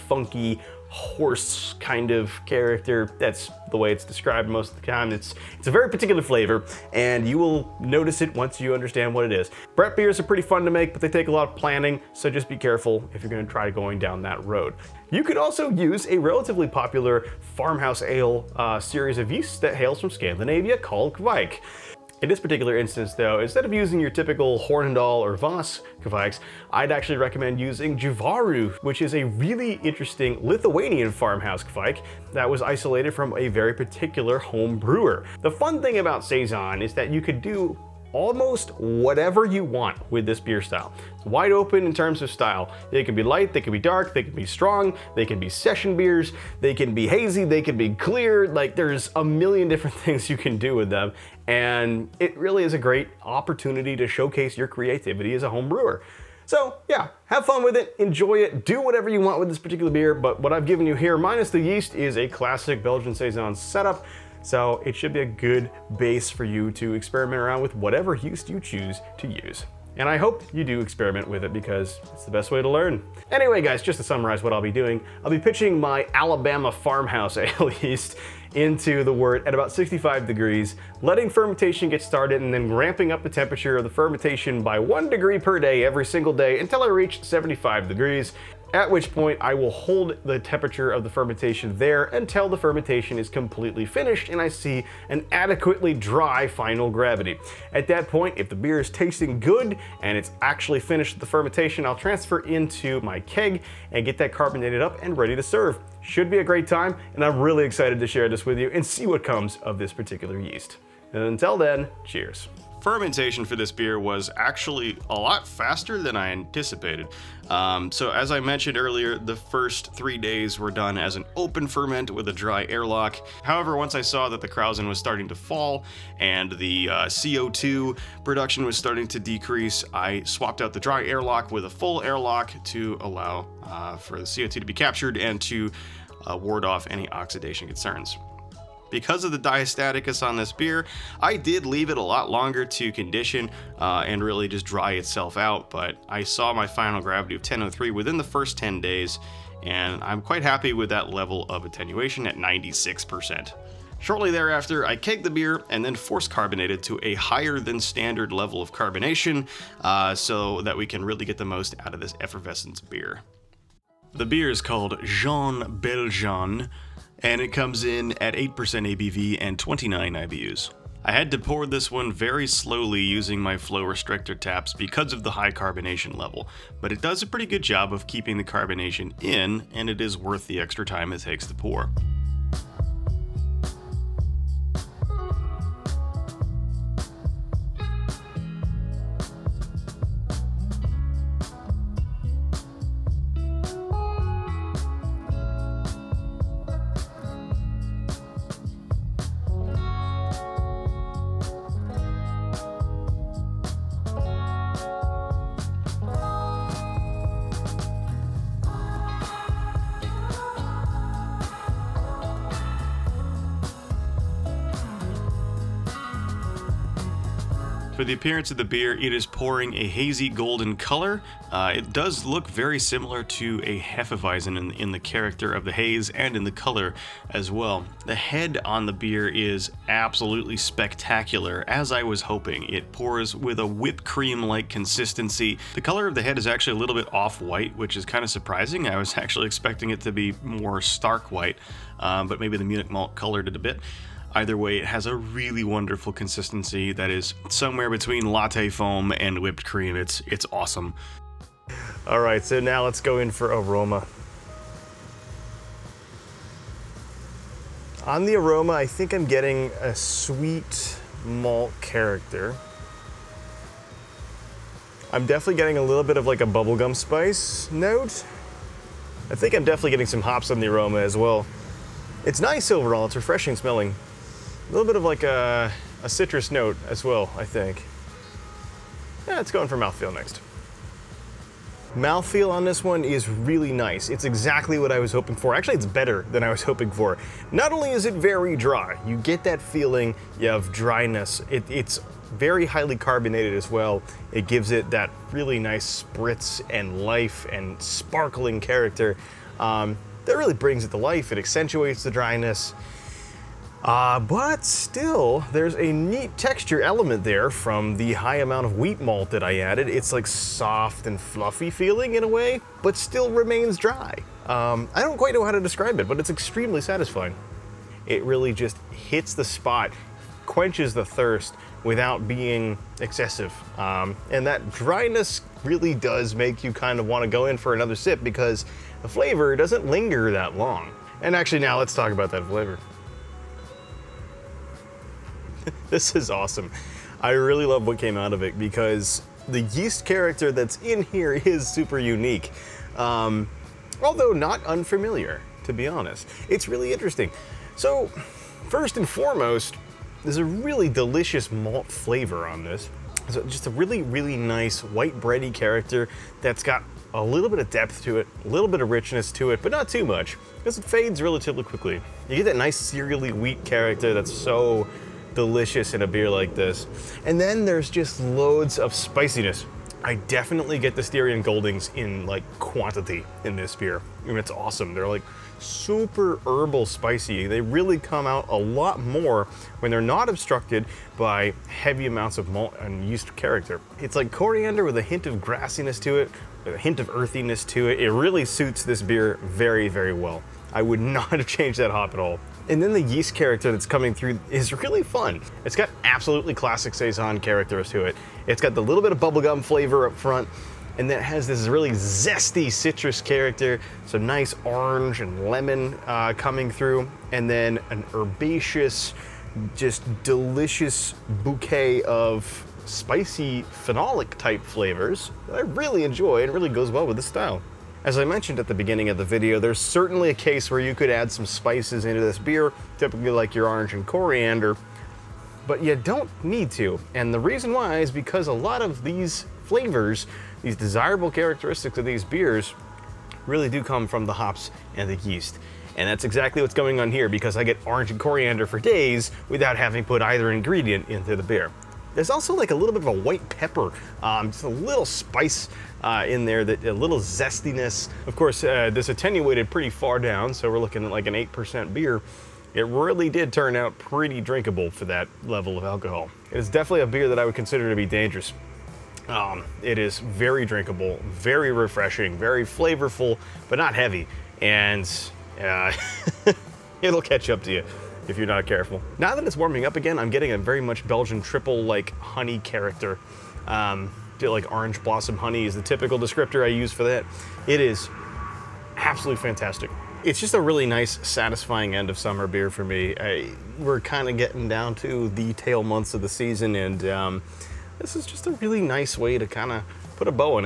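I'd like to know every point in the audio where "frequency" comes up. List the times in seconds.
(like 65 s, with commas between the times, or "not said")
not said.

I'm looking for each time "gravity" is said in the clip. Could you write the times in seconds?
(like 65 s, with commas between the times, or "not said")
96 s, 147 s.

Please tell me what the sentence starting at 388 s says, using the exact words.
It really suits this beer very, very well.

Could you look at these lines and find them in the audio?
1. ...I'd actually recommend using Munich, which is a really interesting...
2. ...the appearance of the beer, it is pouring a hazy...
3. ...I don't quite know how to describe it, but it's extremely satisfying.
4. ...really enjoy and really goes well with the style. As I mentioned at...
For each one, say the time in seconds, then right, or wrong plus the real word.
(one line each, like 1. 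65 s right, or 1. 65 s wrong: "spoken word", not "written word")
1. 26 s wrong: "Jovaru", not "Munich"
2. 218 s right
3. 314 s right
4. 415 s right.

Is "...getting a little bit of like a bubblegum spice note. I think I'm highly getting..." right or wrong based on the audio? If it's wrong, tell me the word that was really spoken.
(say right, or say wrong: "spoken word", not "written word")
wrong: "definitely", not "highly".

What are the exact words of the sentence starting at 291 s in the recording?
It, it's very highly carbonated as well.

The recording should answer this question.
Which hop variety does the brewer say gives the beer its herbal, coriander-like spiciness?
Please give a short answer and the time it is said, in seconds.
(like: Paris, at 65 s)
Styrian Goldings, at 371 s.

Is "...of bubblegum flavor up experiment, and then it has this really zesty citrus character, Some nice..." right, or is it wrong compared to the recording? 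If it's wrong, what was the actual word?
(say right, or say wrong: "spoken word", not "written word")
wrong: "front", not "experiment".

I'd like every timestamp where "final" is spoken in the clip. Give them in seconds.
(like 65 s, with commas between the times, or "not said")
96 s, 146 s.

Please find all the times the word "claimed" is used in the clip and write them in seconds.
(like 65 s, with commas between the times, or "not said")
not said.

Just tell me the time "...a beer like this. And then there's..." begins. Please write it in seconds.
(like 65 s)
366 s.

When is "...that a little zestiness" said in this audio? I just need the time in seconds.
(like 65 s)
446 s.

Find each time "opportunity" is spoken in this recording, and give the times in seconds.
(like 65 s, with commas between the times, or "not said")
53 s.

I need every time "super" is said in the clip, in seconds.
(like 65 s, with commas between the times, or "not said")
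341 s, 375 s.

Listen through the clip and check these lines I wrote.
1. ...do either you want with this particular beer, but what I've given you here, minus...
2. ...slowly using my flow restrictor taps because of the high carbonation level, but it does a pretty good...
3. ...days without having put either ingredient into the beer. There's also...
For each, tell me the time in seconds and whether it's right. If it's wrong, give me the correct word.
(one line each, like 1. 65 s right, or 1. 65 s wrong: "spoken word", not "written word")
1. 58 s wrong: "whatever", not "either"
2. 172 s right
3. 438 s right.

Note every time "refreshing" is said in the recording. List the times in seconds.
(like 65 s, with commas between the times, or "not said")
273 s, 461 s.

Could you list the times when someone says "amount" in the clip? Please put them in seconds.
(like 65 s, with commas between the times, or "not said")
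308 s, 382 s.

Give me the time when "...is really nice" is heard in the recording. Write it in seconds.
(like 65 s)
283 s.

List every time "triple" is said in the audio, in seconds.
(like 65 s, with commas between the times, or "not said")
471 s.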